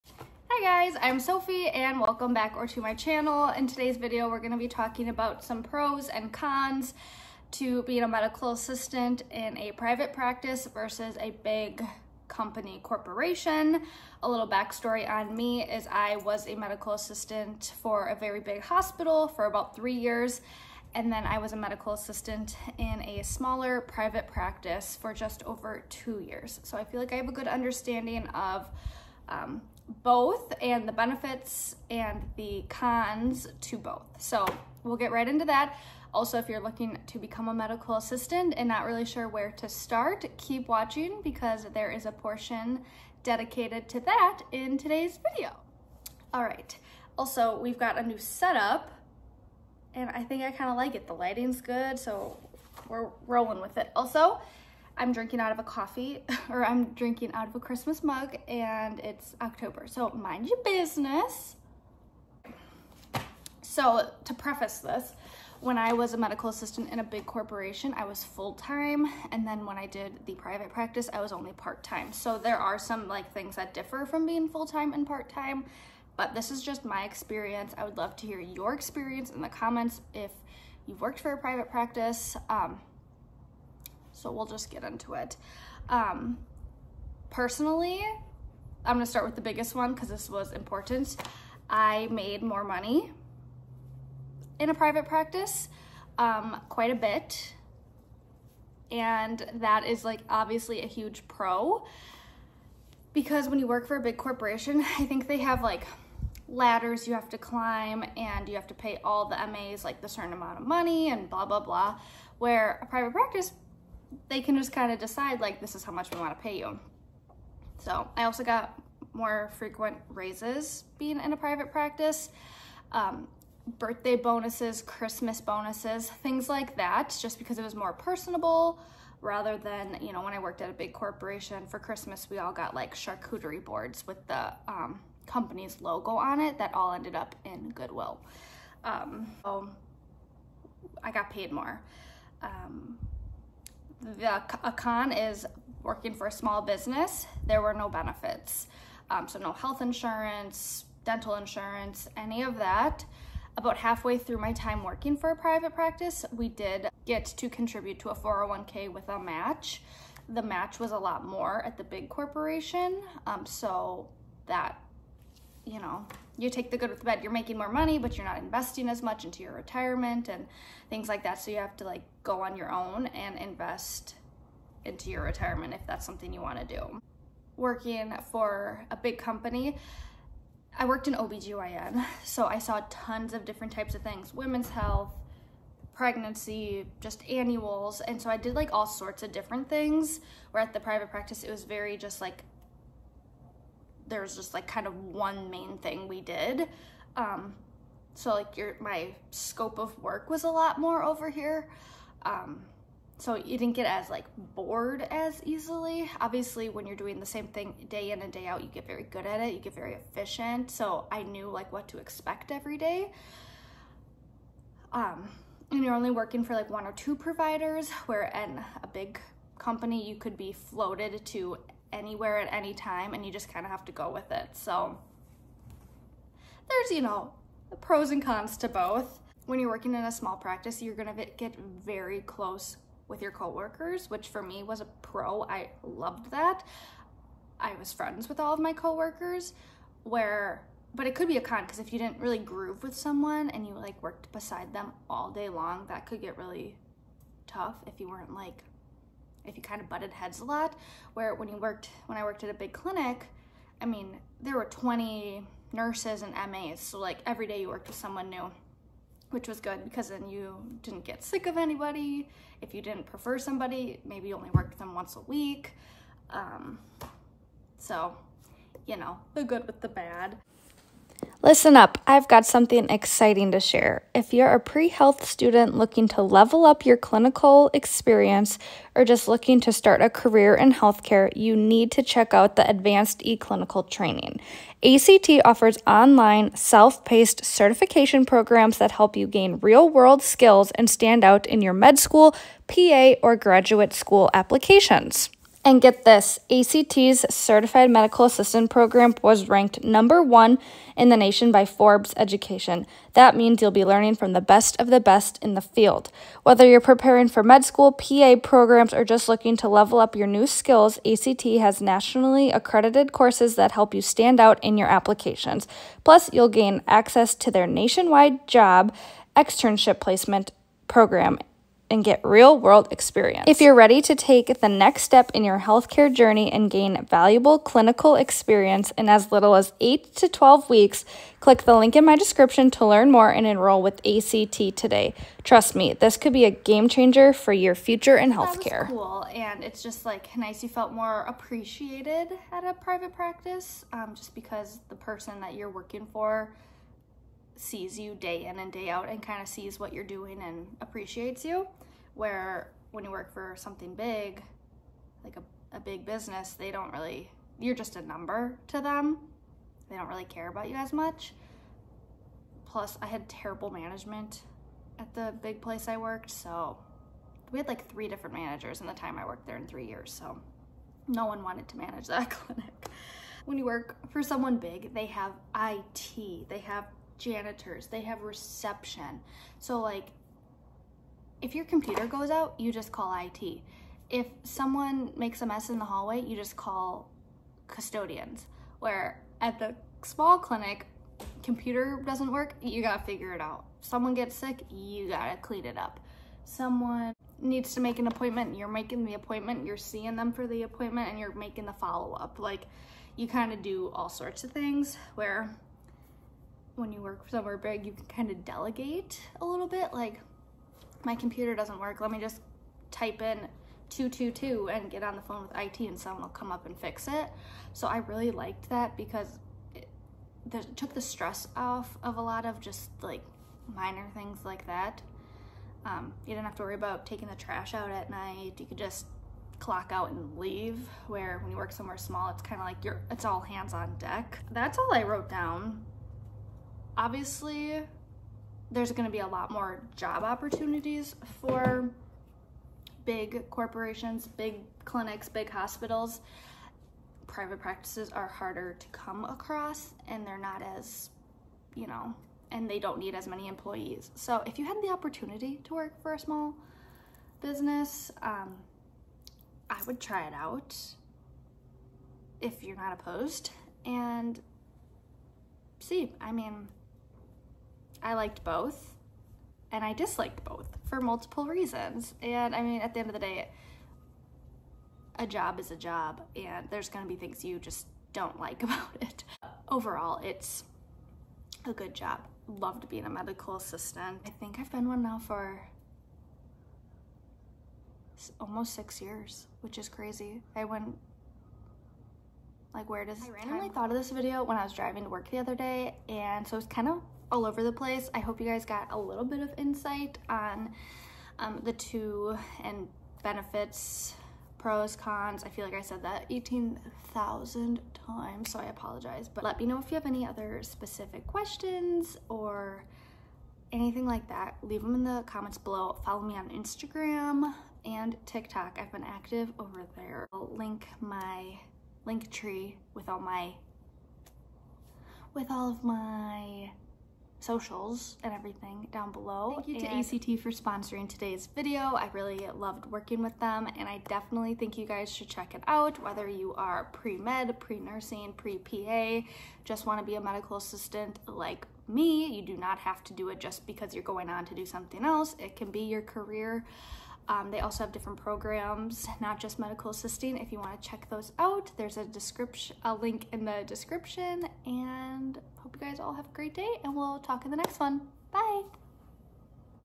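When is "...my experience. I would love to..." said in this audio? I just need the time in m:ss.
1:16.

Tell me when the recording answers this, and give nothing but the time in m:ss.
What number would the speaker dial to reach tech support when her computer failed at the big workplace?
6:53.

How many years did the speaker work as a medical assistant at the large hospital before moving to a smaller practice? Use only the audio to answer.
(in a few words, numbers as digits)
3.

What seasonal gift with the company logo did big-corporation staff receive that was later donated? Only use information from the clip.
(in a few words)
Charcuterie boards.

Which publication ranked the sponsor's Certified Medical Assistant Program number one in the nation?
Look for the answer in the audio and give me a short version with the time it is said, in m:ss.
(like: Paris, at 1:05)
Forbes Education, at 5:01.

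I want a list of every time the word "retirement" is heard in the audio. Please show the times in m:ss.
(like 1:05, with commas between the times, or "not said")
2:49, 2:55.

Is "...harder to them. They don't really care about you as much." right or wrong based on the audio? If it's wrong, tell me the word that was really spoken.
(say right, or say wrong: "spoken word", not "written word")
wrong: "number", not "harder".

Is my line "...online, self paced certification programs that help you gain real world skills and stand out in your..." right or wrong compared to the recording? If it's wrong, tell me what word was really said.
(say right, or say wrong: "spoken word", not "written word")
right.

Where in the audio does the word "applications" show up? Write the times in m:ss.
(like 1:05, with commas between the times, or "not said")
4:54, 5:14.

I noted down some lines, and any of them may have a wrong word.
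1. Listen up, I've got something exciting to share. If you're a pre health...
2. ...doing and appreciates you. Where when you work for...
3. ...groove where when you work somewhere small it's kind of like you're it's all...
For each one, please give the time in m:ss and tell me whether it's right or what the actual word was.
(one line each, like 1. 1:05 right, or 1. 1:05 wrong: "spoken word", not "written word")
1. 4:31 right
2. 5:50 right
3. 7:10 wrong: "leave", not "groove".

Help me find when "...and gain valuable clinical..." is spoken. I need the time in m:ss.
5:26.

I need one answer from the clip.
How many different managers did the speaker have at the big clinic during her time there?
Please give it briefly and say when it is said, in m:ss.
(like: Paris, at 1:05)
3, at 6:07.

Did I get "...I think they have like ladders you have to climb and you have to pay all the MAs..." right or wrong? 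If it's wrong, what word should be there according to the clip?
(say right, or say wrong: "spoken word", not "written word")
right.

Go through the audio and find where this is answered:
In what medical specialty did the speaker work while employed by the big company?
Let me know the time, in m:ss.
3:01.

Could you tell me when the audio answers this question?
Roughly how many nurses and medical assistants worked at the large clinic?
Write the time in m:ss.
4:14.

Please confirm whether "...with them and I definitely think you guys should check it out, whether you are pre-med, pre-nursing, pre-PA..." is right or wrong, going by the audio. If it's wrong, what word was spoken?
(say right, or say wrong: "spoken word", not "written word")
right.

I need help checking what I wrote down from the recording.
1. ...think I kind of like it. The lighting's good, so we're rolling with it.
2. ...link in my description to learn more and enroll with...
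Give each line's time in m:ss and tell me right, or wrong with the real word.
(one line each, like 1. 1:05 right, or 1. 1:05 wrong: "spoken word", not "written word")
1. 0:50 right
2. 5:31 right.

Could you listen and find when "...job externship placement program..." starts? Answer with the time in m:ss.
5:18.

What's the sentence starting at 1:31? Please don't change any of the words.
I made more money in a private practice, um, quite a bit.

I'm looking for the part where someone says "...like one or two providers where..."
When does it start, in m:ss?
3:36.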